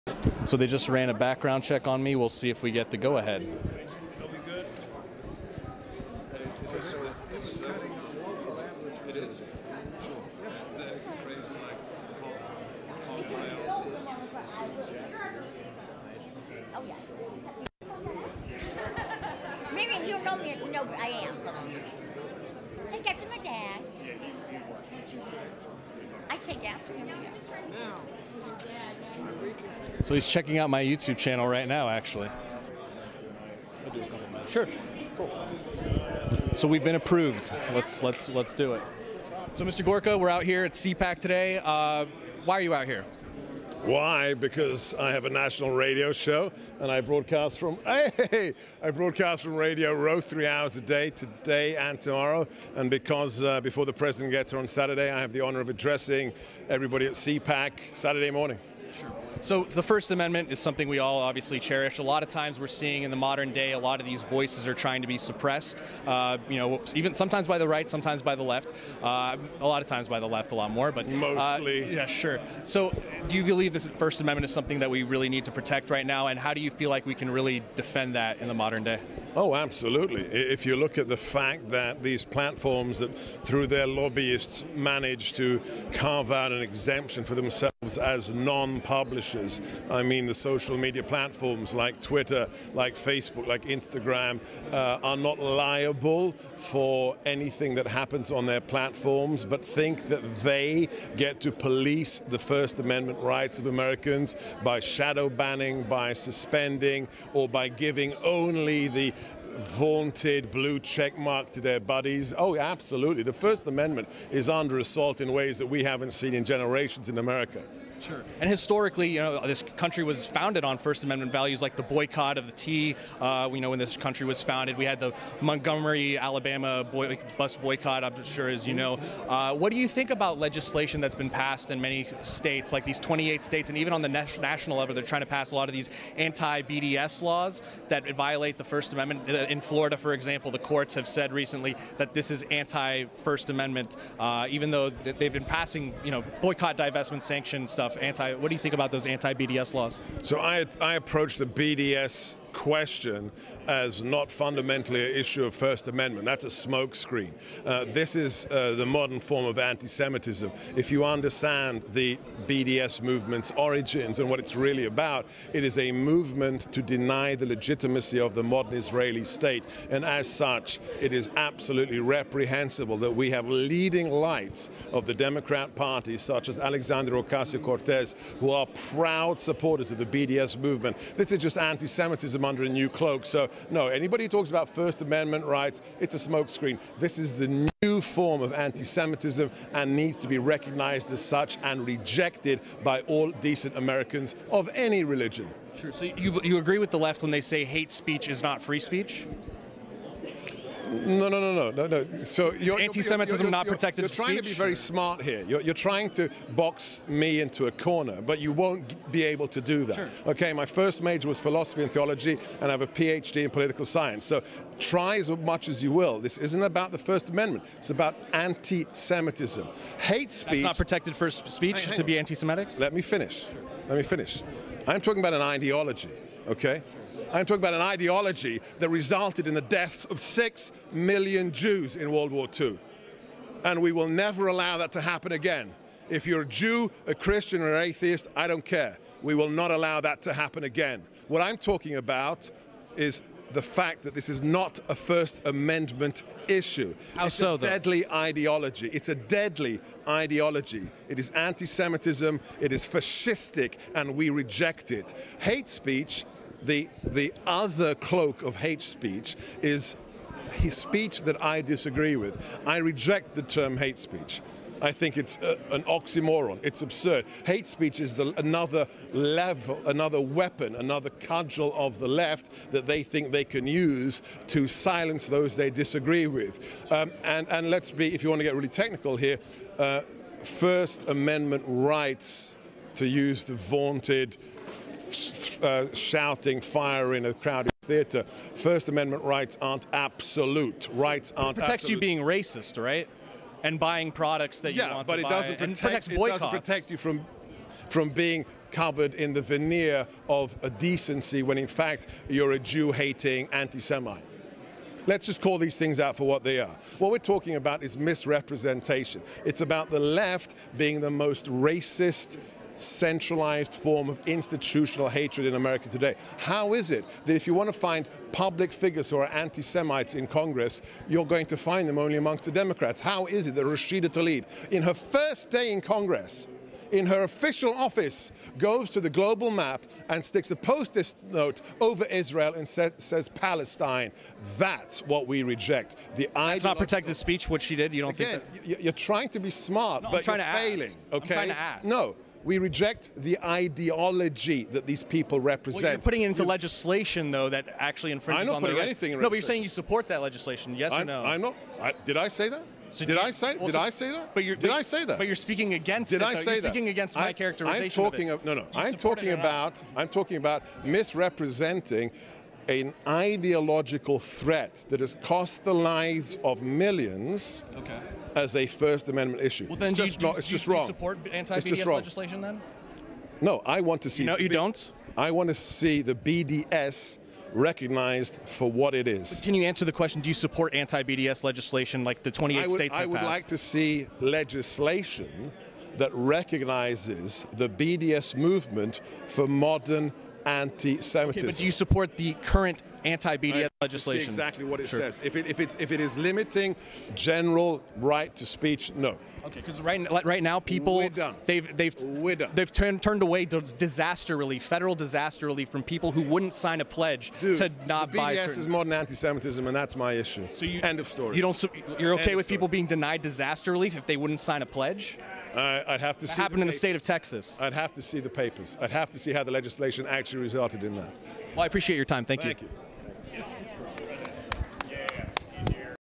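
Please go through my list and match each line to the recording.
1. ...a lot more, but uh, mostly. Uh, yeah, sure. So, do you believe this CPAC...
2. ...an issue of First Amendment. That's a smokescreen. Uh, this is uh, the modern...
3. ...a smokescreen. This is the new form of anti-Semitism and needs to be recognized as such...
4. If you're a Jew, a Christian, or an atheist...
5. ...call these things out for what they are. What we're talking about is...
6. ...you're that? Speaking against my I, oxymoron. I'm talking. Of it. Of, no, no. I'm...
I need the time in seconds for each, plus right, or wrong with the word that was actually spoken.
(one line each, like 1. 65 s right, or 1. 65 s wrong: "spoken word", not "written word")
1. 70 s wrong: "First", not "CPAC"
2. 155 s right
3. 186 s right
4. 236 s right
5. 305 s right
6. 356 s wrong: "characterization", not "oxymoron".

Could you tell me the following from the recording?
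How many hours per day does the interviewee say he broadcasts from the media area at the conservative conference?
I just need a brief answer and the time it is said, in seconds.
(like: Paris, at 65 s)
3, at 50 s.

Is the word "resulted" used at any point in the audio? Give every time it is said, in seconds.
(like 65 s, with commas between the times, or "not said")
228 s, 420 s.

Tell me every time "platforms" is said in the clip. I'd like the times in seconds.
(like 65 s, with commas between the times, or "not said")
82 s, 91 s, 98 s.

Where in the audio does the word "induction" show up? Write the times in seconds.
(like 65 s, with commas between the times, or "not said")
not said.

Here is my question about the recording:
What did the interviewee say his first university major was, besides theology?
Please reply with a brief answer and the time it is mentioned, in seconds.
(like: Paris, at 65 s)
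Philosophy, at 211 s.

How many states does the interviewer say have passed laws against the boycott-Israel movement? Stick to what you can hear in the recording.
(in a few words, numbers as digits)
28.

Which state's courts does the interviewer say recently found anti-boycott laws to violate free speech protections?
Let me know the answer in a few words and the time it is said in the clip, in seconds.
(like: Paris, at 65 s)
Florida, at 139 s.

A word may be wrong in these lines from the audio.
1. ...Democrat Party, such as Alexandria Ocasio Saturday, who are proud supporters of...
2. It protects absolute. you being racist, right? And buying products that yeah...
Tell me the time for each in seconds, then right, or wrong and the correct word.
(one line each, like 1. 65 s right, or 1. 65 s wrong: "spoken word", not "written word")
1. 175 s wrong: "Cortez", not "Saturday"
2. 291 s right.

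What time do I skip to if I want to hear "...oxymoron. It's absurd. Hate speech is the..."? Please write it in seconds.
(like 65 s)
265 s.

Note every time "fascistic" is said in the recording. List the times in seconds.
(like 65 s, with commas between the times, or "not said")
252 s.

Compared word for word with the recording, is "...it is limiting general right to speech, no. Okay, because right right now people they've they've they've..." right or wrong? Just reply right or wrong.
right.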